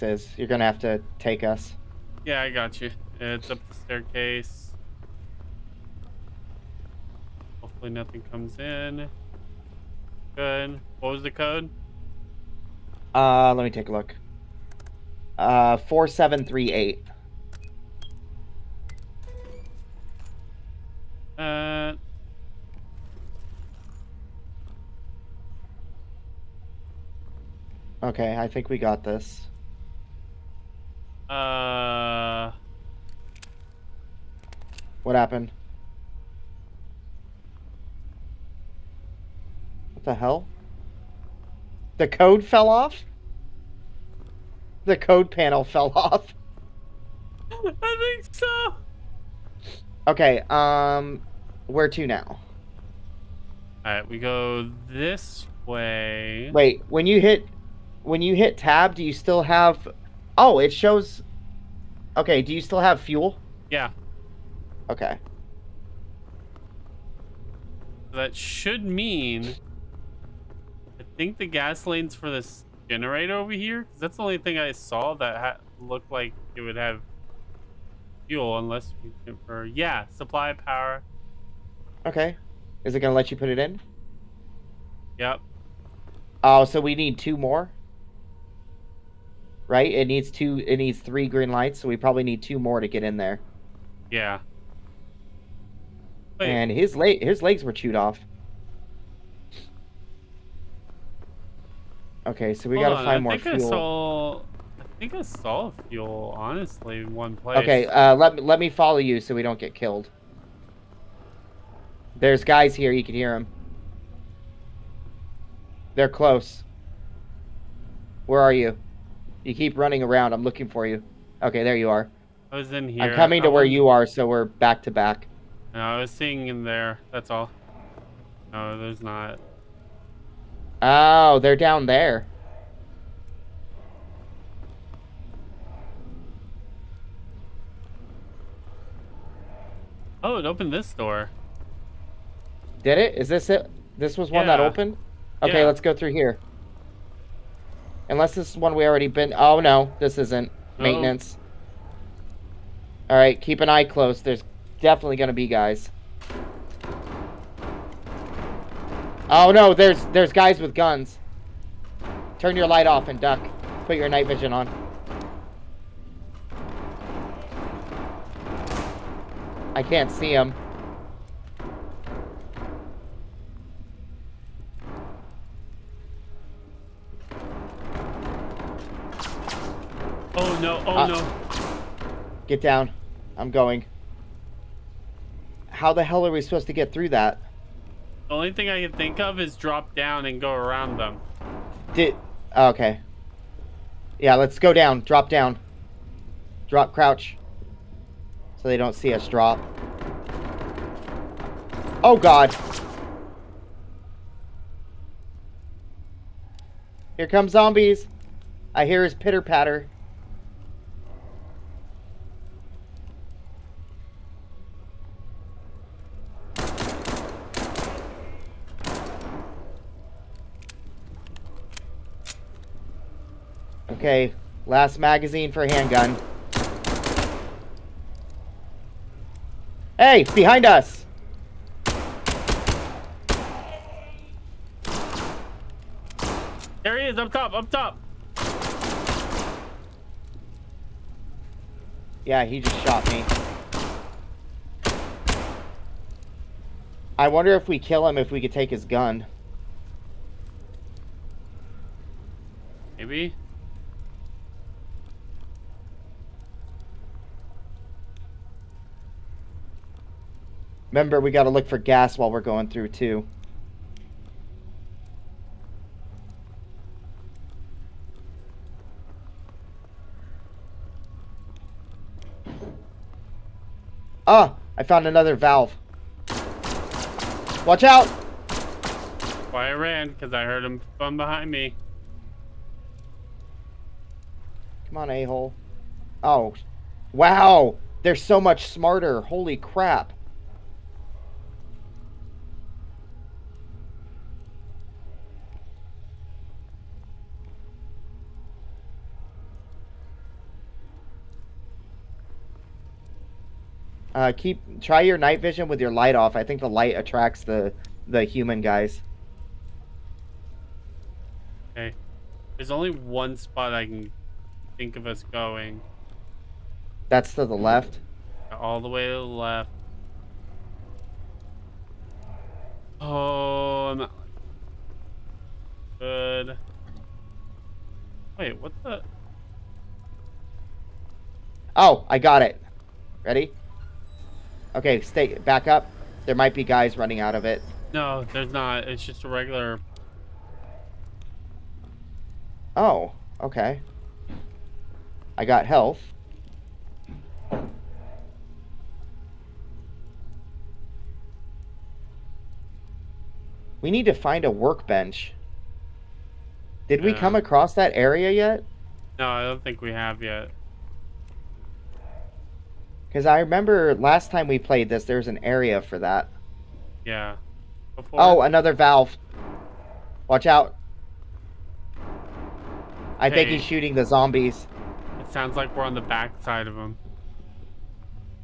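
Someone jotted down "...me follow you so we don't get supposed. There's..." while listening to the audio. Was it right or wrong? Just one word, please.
wrong.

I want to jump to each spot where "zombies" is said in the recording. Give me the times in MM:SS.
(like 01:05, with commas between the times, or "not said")
03:27, 06:14.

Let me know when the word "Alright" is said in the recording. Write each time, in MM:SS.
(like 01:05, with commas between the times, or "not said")
00:53, 02:33.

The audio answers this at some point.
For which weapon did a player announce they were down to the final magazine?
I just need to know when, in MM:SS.
03:45.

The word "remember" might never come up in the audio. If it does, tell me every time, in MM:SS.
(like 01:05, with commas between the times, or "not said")
04:20, 06:03.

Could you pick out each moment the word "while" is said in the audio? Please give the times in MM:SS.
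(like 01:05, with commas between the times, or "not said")
04:22.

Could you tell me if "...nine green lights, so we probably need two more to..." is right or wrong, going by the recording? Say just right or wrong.
wrong.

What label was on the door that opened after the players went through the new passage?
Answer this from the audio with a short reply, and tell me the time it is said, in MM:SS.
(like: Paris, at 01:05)
Maintenance, at 02:30.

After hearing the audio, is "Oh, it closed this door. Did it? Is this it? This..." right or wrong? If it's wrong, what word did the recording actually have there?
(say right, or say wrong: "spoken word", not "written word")
wrong: "opened", not "closed".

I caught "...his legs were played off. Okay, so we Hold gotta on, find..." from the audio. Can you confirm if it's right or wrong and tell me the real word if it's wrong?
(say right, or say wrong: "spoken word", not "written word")
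wrong: "chewed", not "played".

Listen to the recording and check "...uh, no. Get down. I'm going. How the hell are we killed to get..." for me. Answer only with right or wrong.
wrong.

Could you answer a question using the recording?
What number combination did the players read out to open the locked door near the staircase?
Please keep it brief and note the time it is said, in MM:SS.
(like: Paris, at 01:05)
4738, at 00:15.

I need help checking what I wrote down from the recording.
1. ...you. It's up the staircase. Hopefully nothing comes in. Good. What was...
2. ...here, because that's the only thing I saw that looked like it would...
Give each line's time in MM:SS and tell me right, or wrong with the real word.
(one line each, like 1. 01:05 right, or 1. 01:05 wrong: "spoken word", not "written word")
1. 00:02 right
2. 01:13 right.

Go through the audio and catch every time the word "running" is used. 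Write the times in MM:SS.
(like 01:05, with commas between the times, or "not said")
01:59, 05:36.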